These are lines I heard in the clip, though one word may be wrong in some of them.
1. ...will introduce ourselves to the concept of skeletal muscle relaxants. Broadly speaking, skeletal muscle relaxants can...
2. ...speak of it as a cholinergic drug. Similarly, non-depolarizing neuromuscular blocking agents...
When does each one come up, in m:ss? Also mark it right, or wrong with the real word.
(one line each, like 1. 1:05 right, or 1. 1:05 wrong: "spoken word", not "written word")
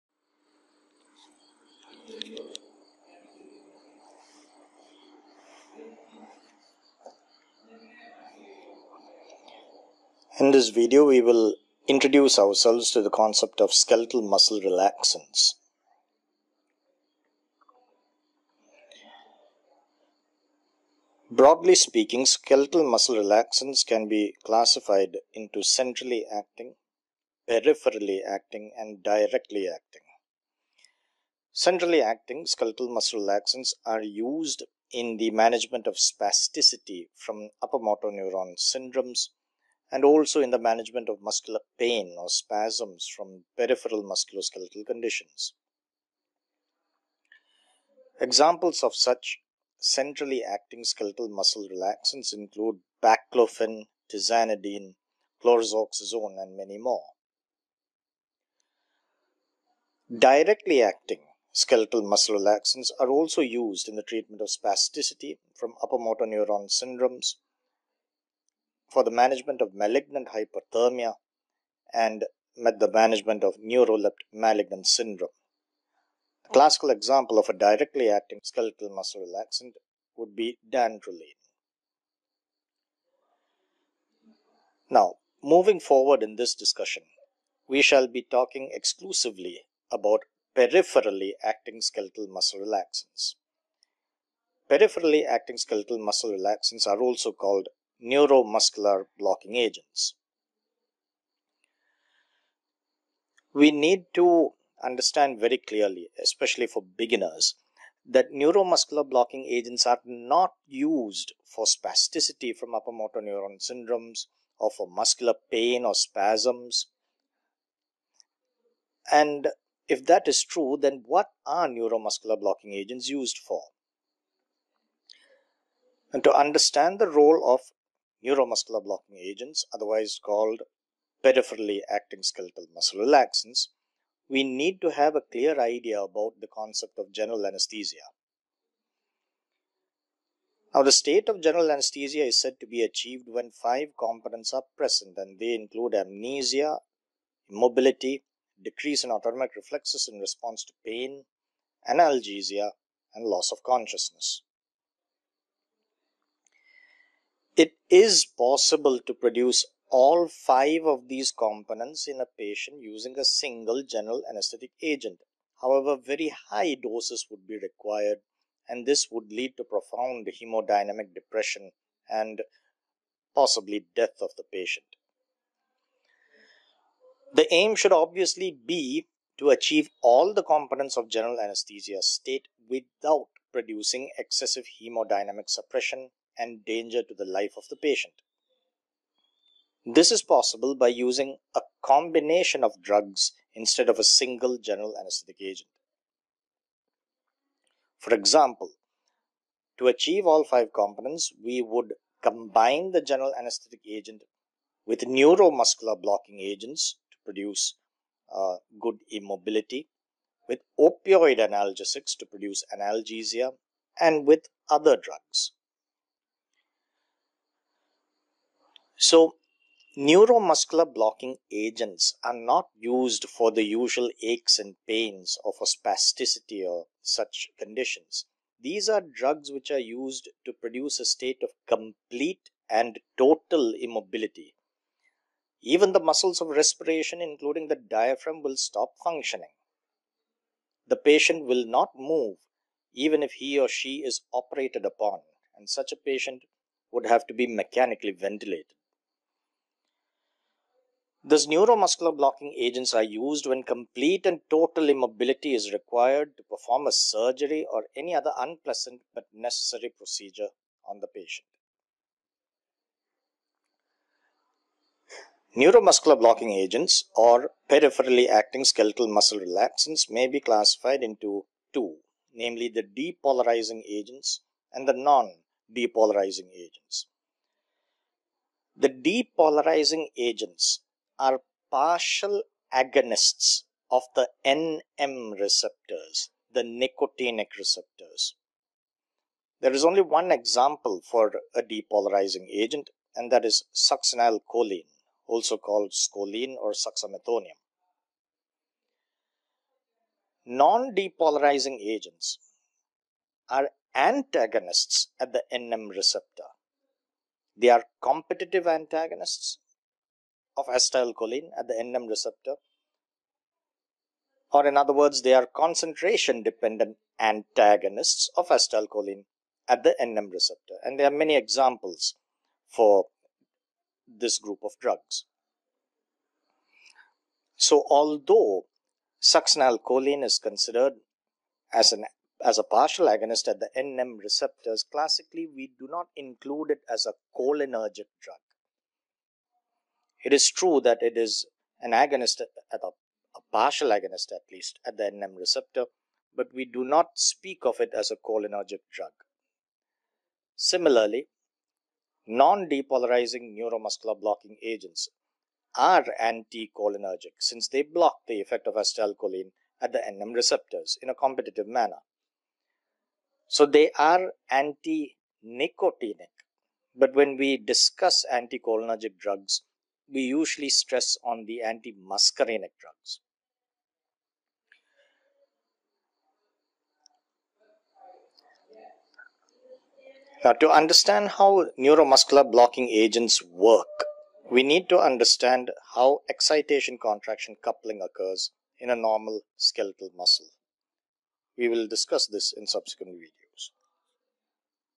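1. 0:11 right
2. 5:47 right.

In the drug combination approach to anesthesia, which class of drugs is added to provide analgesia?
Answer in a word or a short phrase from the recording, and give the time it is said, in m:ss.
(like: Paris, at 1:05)
Opioid analgesics, at 3:30.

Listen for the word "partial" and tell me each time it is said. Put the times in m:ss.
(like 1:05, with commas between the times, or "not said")
4:41, 5:32, 5:43.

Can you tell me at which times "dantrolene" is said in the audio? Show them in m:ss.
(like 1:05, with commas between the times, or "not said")
1:20.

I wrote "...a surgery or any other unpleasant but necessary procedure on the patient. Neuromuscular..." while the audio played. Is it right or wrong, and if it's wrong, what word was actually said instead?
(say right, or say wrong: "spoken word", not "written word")
right.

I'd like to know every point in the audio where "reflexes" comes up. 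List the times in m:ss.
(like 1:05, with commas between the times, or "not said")
2:29.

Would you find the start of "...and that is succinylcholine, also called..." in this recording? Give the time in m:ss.
4:53.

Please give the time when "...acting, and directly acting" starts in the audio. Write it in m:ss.
0:28.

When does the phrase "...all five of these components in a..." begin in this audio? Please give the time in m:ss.
2:39.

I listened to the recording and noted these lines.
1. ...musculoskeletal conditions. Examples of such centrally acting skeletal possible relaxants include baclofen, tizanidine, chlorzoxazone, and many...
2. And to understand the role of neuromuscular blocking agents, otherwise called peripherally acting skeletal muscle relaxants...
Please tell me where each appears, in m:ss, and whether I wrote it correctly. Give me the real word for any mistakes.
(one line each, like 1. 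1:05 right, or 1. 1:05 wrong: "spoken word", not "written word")
1. 0:44 wrong: "muscle", not "possible"
2. 2:06 right.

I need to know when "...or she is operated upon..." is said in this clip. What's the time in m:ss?
4:03.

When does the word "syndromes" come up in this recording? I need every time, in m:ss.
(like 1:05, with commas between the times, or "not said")
0:38, 1:06, 1:14, 1:53.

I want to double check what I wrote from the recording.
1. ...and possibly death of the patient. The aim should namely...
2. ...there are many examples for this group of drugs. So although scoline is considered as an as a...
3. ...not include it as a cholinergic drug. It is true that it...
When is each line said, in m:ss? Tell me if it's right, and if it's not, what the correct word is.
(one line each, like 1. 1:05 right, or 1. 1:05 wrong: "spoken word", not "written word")
1. 2:52 wrong: "obviously", not "namely"
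2. 5:20 wrong: "succinylcholine", not "scoline"
3. 5:35 right.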